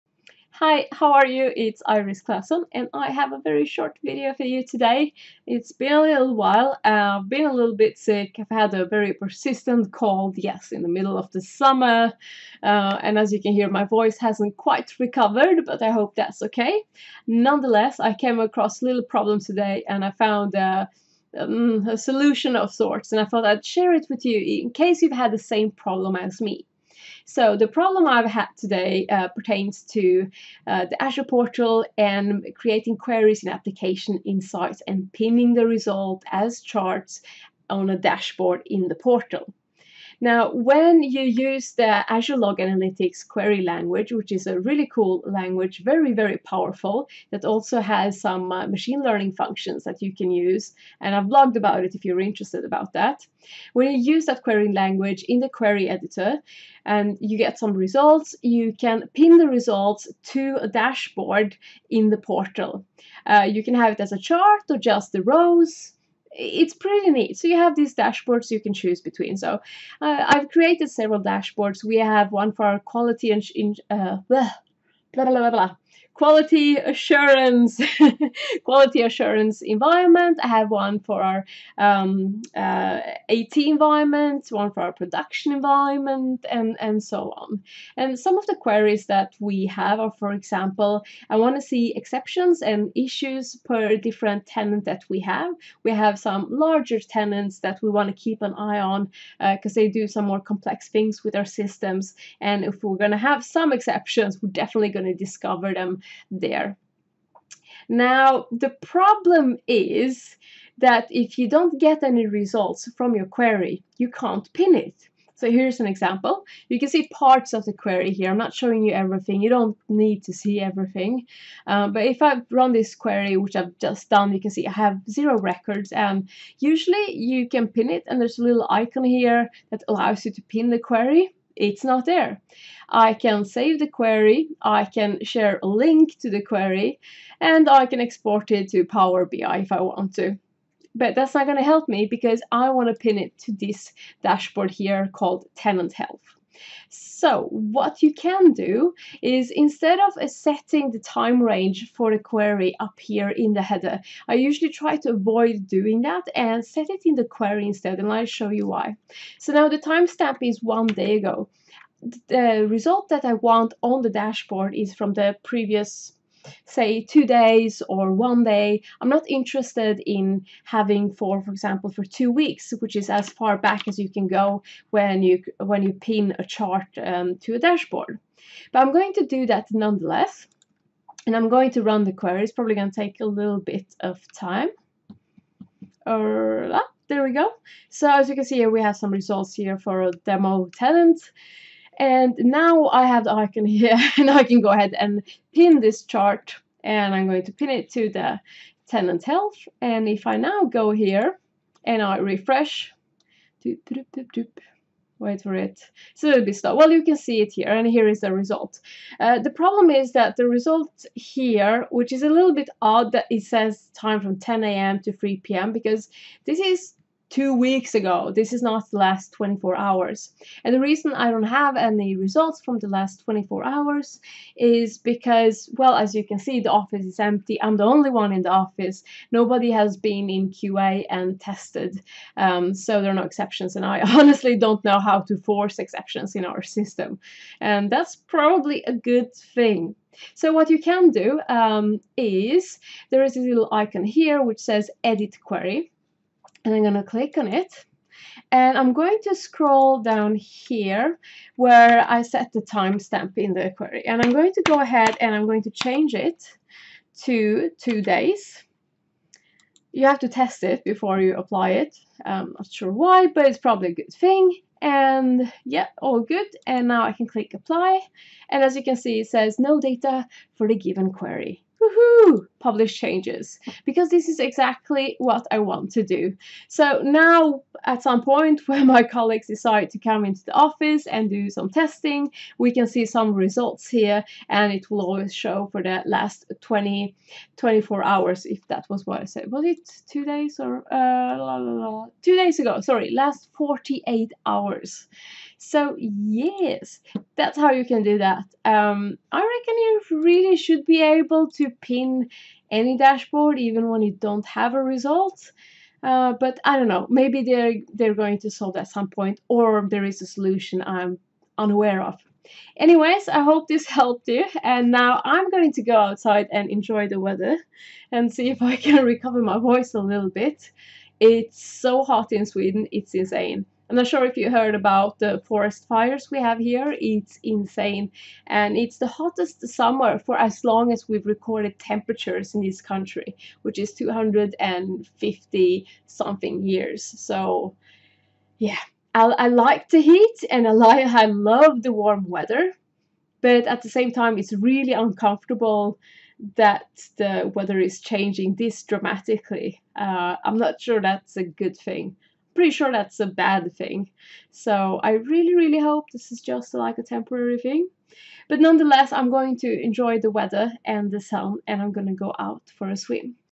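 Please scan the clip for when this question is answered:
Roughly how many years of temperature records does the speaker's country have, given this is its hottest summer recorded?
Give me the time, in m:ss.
5:33.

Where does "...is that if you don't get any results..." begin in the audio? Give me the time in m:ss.
1:49.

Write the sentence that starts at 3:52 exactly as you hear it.
Um, so there are no exceptions.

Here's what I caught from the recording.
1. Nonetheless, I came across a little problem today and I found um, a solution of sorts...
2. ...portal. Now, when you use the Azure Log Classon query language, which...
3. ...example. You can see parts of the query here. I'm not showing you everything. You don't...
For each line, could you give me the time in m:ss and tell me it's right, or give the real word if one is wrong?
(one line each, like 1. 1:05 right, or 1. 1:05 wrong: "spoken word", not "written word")
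1. 0:17 right
2. 0:38 wrong: "Analytics", not "Classon"
3. 1:55 right.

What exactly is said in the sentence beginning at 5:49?
Uh, I'm not sure that's a good thing pretty sure that's a bad thing.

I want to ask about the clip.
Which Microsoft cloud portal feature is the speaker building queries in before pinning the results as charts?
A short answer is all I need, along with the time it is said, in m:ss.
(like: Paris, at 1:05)
Application Insights, at 0:33.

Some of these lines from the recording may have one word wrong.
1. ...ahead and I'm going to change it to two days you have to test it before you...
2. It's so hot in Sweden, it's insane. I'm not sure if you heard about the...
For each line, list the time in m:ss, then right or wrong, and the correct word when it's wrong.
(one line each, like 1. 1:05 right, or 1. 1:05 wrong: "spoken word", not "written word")
1. 4:14 right
2. 5:21 right.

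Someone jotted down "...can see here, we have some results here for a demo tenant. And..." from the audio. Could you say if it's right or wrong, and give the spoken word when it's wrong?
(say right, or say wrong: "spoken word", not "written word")
right.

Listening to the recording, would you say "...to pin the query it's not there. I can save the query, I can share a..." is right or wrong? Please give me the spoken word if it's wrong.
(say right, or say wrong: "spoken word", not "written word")
right.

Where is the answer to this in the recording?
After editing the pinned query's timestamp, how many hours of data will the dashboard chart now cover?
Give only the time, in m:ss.
4:53.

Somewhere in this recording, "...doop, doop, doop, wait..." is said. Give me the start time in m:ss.
3:23.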